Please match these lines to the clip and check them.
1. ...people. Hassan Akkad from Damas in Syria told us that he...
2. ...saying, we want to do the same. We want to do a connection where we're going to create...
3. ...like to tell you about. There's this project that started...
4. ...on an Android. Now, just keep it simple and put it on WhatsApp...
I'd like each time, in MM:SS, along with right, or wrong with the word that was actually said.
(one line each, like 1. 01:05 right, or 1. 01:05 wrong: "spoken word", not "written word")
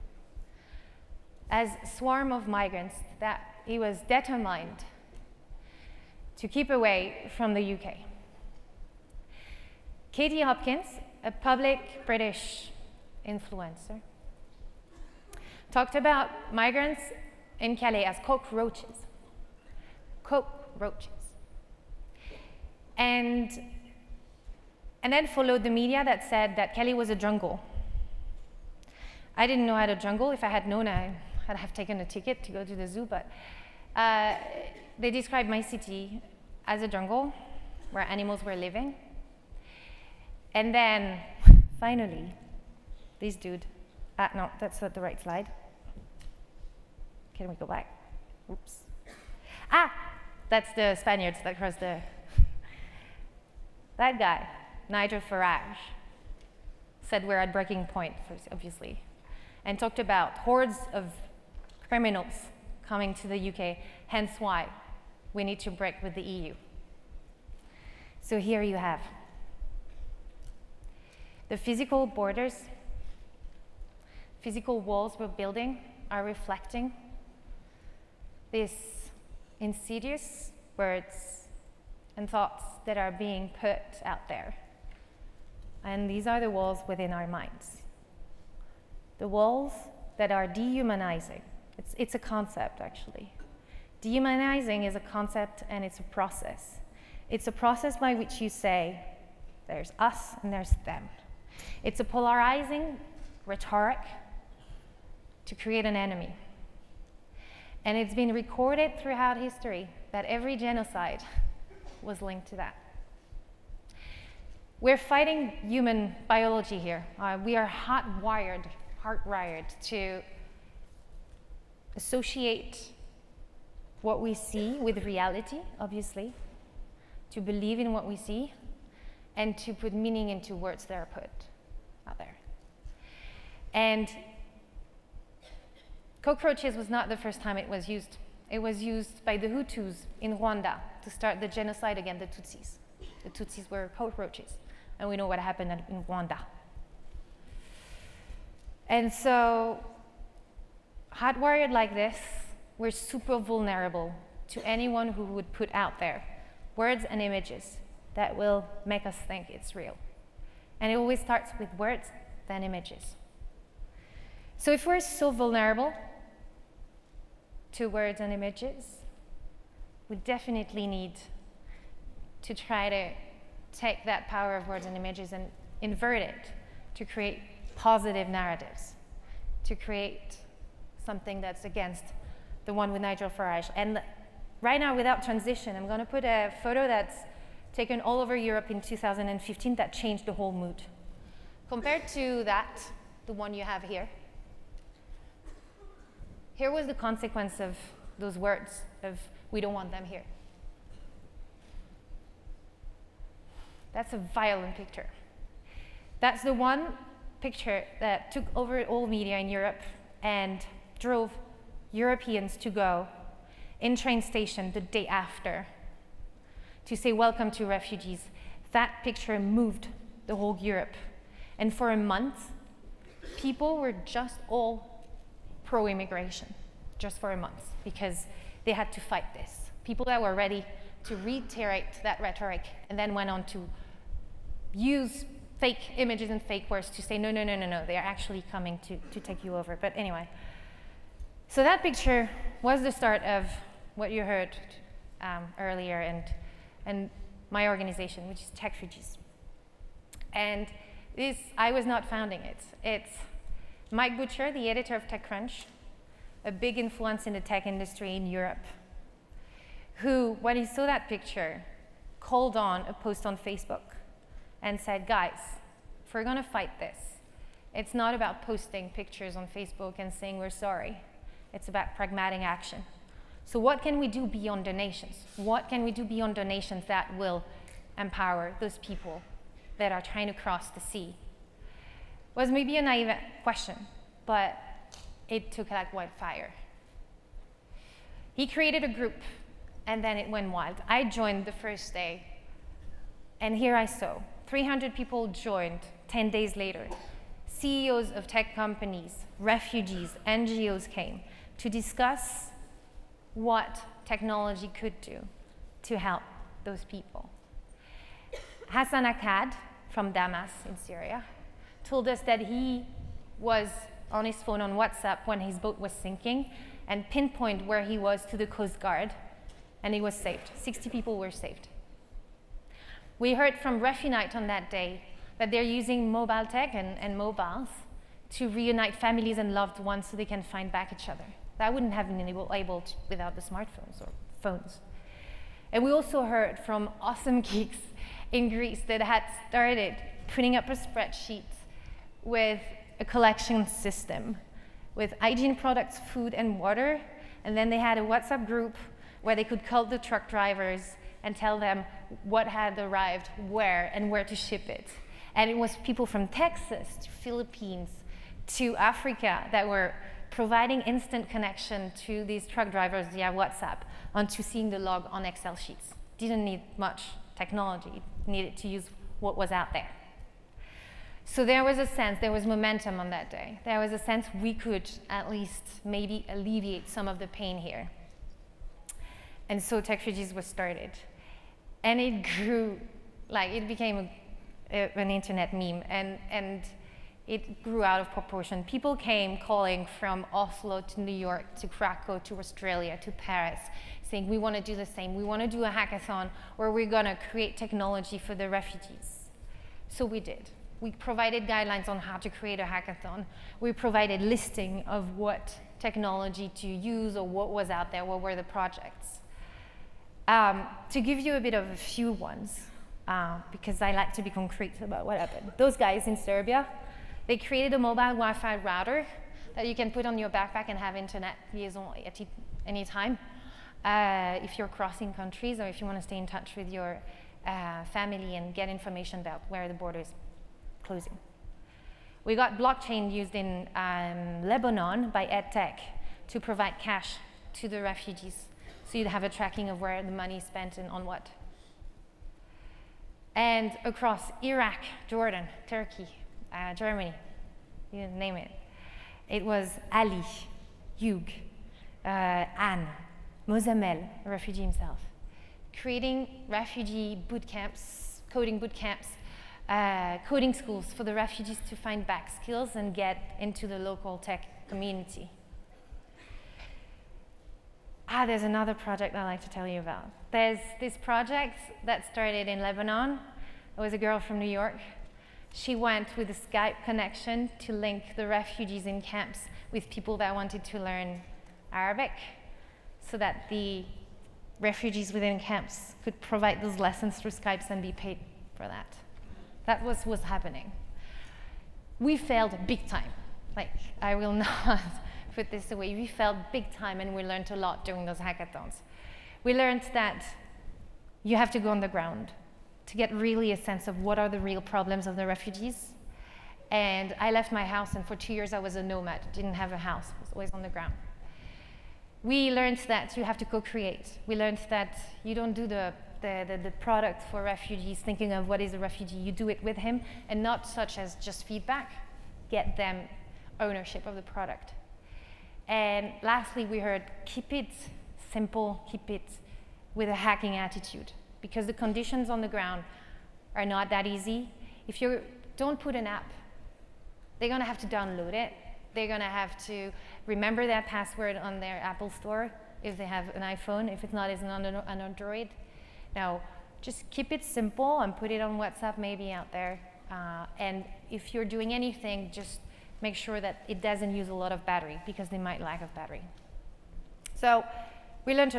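1. 05:06 right
2. 06:34 wrong: "hackathon", not "connection"
3. 07:49 right
4. 09:04 right.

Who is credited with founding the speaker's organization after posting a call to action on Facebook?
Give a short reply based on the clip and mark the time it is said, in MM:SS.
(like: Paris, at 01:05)
Mike Butcher, at 04:13.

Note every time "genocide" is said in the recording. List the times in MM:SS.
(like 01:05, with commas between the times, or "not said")
01:50, 02:21.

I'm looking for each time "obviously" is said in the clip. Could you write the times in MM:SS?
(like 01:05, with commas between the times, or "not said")
00:58, 02:05.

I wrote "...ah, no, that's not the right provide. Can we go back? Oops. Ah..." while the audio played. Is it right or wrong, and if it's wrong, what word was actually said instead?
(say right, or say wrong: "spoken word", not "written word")
wrong: "slide", not "provide".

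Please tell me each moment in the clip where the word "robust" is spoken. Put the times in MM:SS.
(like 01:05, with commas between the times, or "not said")
not said.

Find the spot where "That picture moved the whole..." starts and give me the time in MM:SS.
03:38.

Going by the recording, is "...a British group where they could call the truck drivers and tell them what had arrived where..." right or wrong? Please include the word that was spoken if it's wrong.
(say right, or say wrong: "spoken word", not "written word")
wrong: "WhatsApp", not "British".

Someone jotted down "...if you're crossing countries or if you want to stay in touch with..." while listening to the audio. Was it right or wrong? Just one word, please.
right.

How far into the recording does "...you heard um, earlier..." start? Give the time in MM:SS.
04:04.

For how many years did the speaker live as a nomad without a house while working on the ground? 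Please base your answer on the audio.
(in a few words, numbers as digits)
2.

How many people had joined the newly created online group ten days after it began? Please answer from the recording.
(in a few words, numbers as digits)
300.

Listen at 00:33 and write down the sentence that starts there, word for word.
But uh, they described my city as a jungle where animals were living.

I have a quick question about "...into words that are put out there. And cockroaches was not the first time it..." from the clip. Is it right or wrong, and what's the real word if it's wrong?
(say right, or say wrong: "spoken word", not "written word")
right.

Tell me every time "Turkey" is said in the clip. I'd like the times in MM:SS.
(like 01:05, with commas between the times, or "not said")
07:25.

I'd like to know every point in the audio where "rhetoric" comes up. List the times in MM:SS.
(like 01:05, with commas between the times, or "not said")
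01:43, 03:52.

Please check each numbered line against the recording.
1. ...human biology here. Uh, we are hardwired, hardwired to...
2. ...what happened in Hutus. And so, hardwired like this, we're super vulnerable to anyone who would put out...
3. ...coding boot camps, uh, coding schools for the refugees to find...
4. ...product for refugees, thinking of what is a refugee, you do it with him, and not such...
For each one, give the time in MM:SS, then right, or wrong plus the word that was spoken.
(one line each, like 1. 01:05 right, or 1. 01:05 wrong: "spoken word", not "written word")
1. 01:55 right
2. 02:25 wrong: "Rwanda", not "Hutus"
3. 07:38 right
4. 08:36 right.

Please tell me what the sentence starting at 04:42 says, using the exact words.
It was maybe a naive question, but it took like wildfire.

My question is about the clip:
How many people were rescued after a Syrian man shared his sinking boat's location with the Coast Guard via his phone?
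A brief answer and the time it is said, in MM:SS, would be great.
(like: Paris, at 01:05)
60, at 05:20.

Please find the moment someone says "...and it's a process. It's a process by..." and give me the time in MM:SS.
01:35.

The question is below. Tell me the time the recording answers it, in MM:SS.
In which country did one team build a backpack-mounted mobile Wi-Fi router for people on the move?
06:56.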